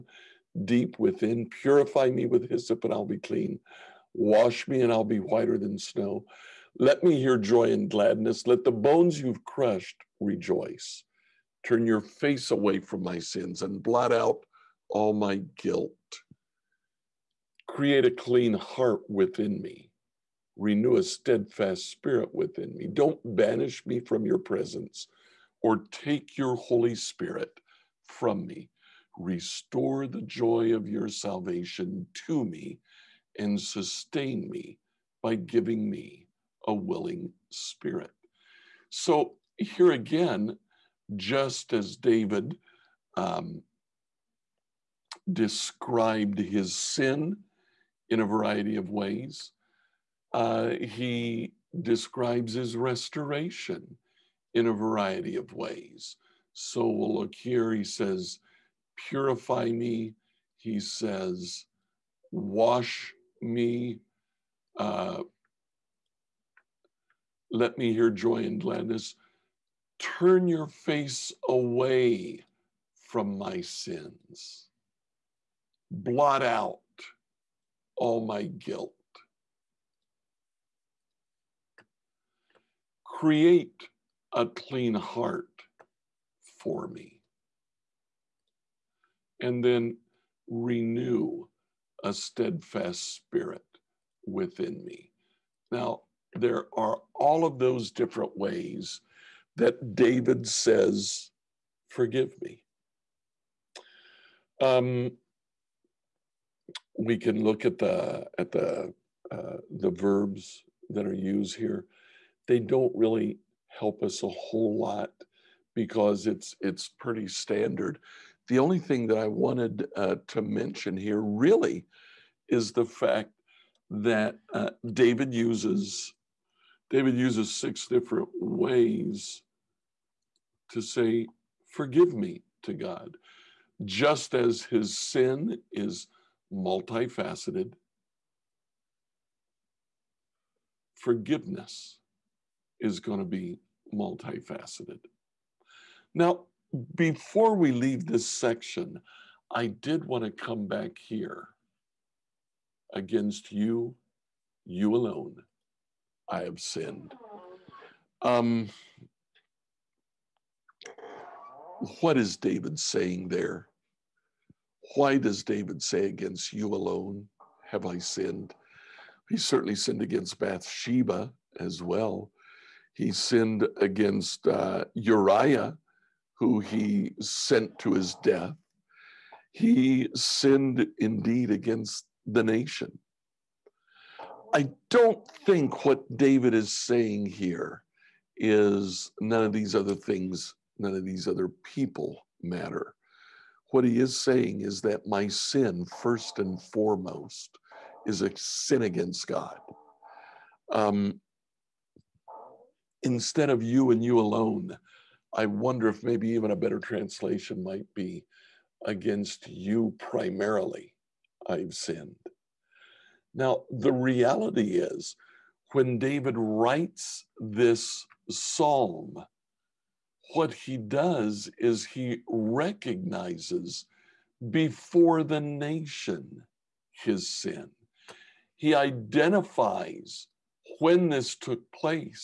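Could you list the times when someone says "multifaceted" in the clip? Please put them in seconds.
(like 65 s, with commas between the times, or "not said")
136 s, 143 s.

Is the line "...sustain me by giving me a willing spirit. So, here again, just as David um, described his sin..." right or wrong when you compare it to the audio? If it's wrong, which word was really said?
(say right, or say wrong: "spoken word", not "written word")
right.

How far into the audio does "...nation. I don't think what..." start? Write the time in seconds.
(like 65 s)
182 s.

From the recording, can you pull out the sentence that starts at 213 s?
Now, the reality is, when David writes this psalm, what he does is he recognizes before the nation his sin.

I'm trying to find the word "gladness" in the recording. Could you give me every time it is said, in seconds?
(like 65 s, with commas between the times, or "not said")
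7 s, 68 s.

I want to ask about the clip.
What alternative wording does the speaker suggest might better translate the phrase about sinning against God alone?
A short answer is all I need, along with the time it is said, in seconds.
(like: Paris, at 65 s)
Against you primarily, at 208 s.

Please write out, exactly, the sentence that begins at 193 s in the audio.
What he is saying is that my sin, first and foremost, is a sin against God.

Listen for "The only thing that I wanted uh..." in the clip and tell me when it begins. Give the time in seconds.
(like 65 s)
118 s.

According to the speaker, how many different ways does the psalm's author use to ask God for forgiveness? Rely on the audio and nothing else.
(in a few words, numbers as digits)
6.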